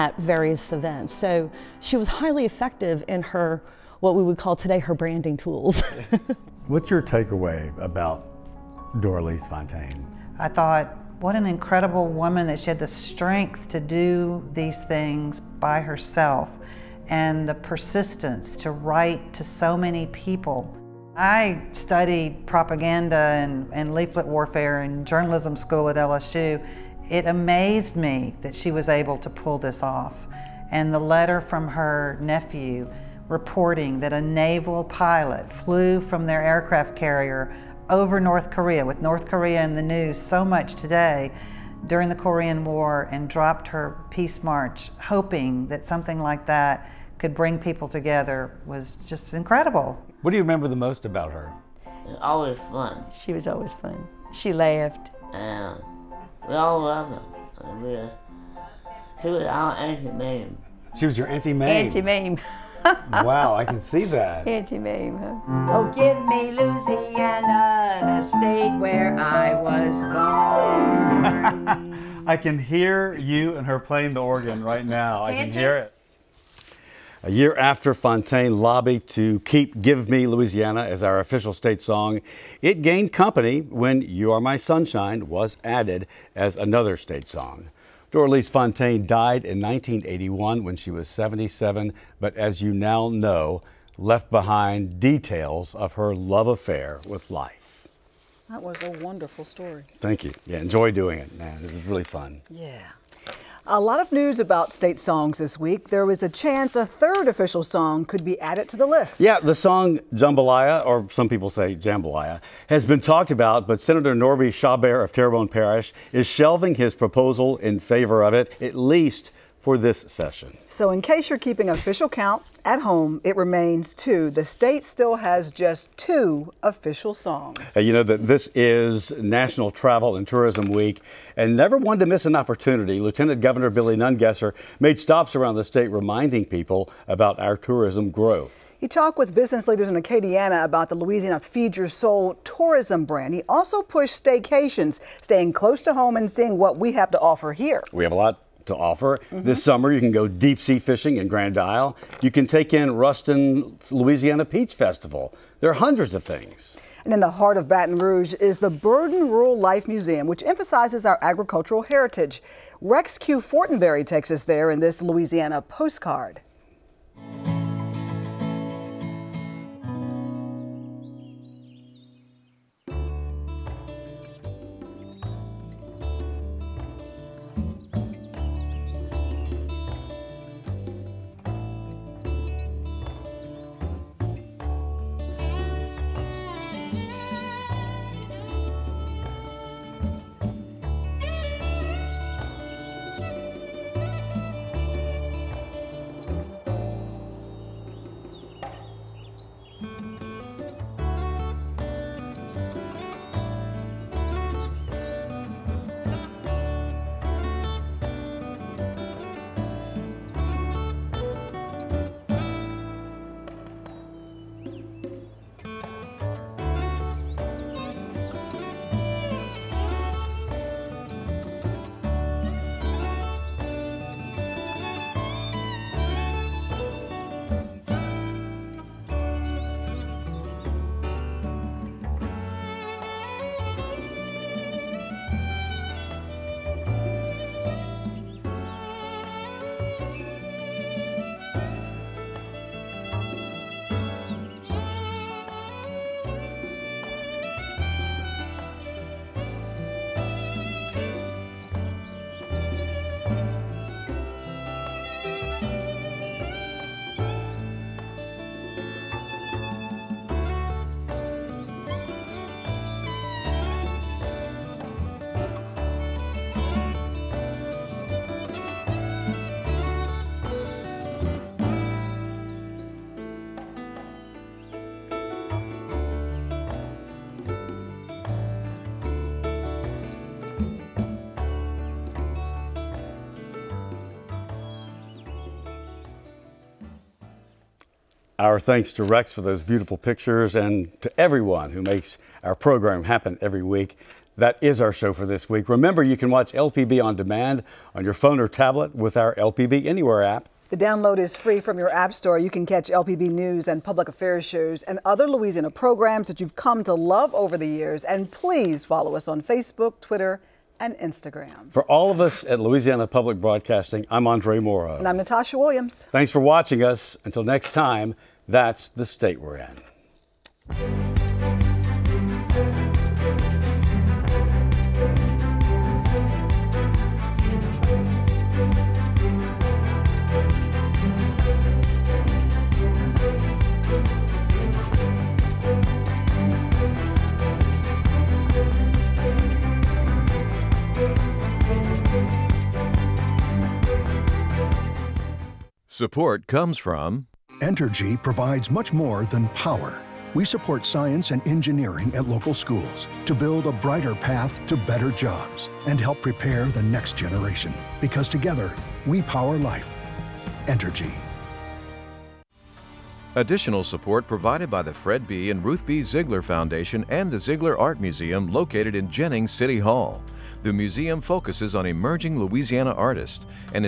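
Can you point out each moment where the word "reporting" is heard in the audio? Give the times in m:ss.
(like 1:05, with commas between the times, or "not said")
0:33.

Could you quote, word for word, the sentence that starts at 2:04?
The state still has just two official songs.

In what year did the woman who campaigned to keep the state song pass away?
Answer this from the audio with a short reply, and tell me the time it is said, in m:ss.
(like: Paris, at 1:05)
1981, at 1:29.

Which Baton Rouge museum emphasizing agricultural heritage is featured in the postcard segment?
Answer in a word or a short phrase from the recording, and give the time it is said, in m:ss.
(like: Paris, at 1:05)
Burden Rural Life Museum, at 2:38.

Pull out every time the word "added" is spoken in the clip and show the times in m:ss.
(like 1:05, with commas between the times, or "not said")
1:25, 1:48.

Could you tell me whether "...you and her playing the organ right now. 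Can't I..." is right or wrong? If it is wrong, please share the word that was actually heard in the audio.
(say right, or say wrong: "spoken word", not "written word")
right.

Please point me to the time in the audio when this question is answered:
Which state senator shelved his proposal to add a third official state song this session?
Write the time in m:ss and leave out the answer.
1:54.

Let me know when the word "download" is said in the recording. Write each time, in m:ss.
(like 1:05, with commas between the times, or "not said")
5:00.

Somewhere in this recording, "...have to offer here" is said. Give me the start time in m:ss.
2:26.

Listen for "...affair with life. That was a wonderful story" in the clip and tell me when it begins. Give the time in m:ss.
1:36.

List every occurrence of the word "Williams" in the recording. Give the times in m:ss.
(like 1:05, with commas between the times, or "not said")
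5:15.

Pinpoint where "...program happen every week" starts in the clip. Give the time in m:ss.
4:52.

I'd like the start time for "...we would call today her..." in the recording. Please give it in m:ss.
0:04.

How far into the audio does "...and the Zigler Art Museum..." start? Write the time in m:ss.
6:07.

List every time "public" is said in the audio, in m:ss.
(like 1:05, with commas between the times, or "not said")
5:03, 5:13.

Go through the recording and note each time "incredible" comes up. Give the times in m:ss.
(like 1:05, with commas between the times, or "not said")
0:11, 0:49.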